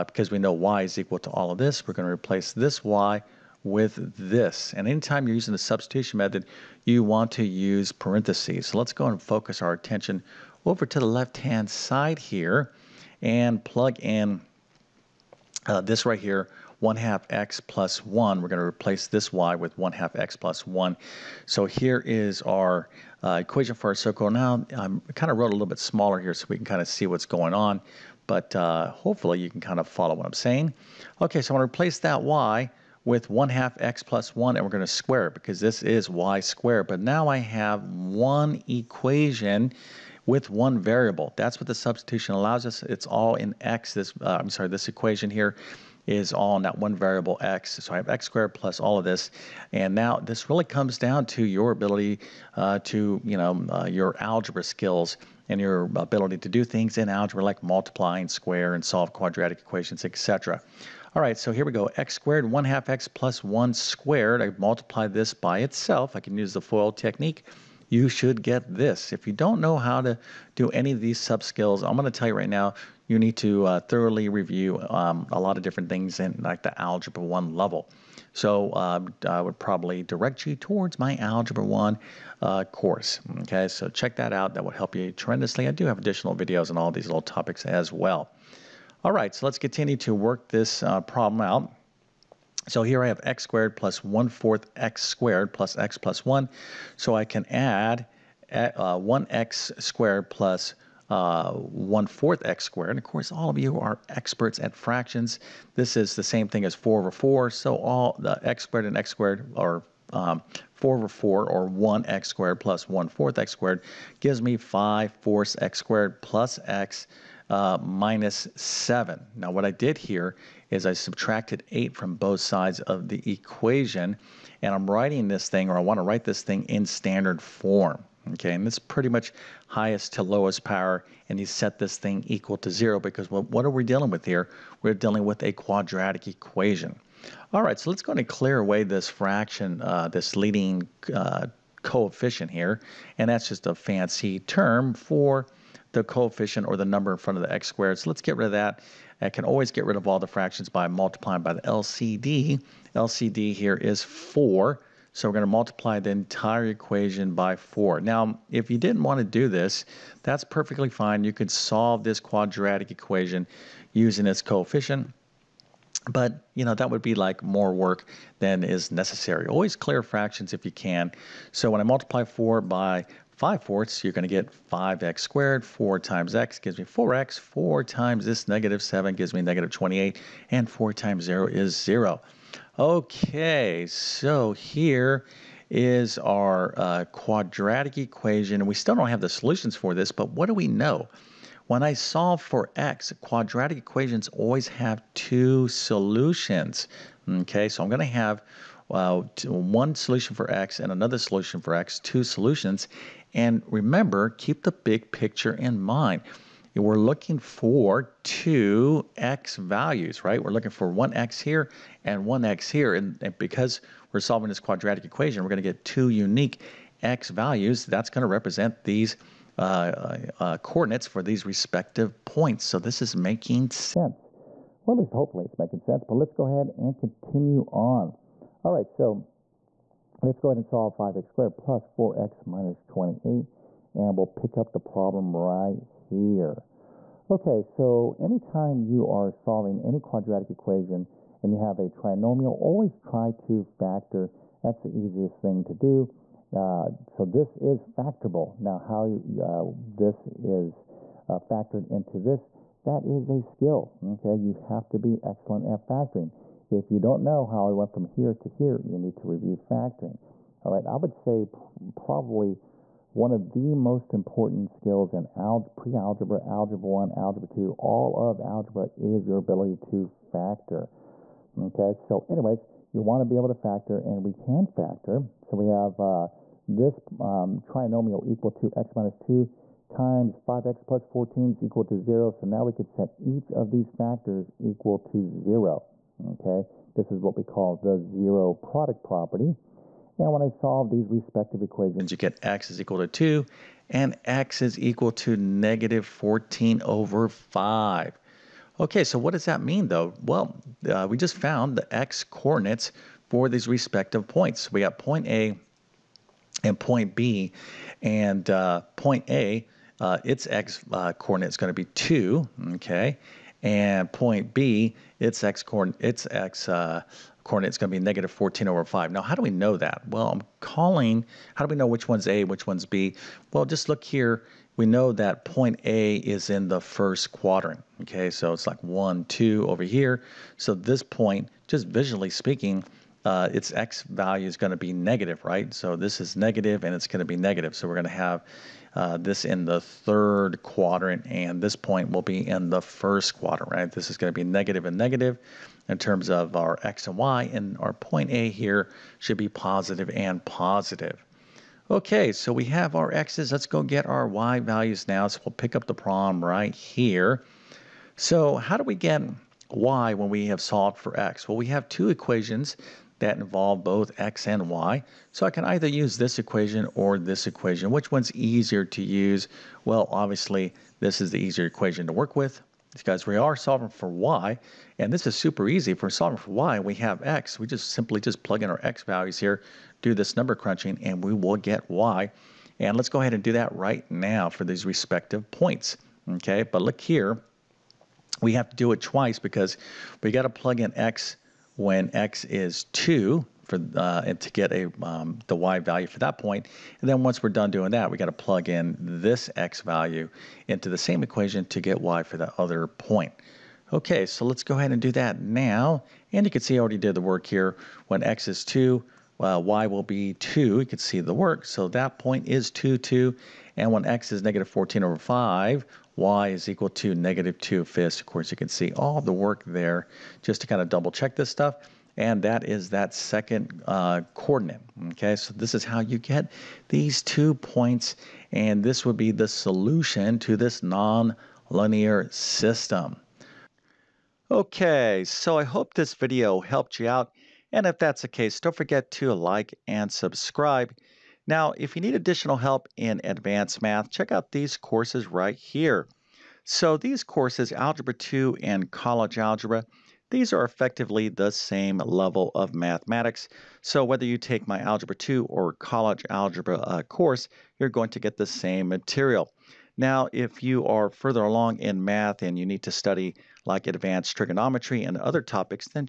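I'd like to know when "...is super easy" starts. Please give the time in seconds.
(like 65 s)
375 s.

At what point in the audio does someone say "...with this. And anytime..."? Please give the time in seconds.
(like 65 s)
3 s.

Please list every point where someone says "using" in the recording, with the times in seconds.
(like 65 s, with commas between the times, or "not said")
5 s, 163 s.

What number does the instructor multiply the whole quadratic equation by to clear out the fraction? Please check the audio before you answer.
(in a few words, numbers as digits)
4.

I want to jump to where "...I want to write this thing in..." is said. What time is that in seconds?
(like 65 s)
125 s.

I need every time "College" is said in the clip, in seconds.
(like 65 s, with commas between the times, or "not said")
448 s, 455 s.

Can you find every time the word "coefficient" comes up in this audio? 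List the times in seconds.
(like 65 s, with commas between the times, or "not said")
141 s, 146 s, 164 s.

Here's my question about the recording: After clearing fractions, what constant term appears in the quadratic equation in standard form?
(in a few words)
-28.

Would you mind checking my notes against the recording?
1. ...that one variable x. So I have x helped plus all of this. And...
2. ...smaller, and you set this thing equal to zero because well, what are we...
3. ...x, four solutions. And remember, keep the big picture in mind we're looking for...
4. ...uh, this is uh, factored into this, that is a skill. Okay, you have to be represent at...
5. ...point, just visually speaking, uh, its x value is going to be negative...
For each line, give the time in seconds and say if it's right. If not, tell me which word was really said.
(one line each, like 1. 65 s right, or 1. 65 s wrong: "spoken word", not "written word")
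1. 46 s wrong: "squared", not "helped"
2. 130 s wrong: "power", not "smaller"
3. 201 s wrong: "two", not "four"
4. 249 s wrong: "excellent", not "represent"
5. 331 s right.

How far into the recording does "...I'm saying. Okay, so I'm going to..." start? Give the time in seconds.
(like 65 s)
30 s.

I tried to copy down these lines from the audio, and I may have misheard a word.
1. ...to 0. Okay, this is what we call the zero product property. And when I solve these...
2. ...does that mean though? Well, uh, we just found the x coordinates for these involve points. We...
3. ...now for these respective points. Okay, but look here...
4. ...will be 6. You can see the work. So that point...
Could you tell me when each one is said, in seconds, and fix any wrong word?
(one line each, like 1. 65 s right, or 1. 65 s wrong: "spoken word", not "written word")
1. 284 s right
2. 299 s wrong: "respective", not "involve"
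3. 384 s right
4. 409 s wrong: "2", not "6".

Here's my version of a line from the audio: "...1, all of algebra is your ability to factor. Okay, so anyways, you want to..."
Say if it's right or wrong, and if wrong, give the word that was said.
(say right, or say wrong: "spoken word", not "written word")
wrong: "2", not "1".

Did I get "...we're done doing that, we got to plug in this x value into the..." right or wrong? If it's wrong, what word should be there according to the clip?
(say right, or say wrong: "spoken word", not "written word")
right.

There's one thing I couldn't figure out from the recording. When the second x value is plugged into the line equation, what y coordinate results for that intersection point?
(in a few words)
-2/5.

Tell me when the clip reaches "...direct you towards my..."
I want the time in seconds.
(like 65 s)
80 s.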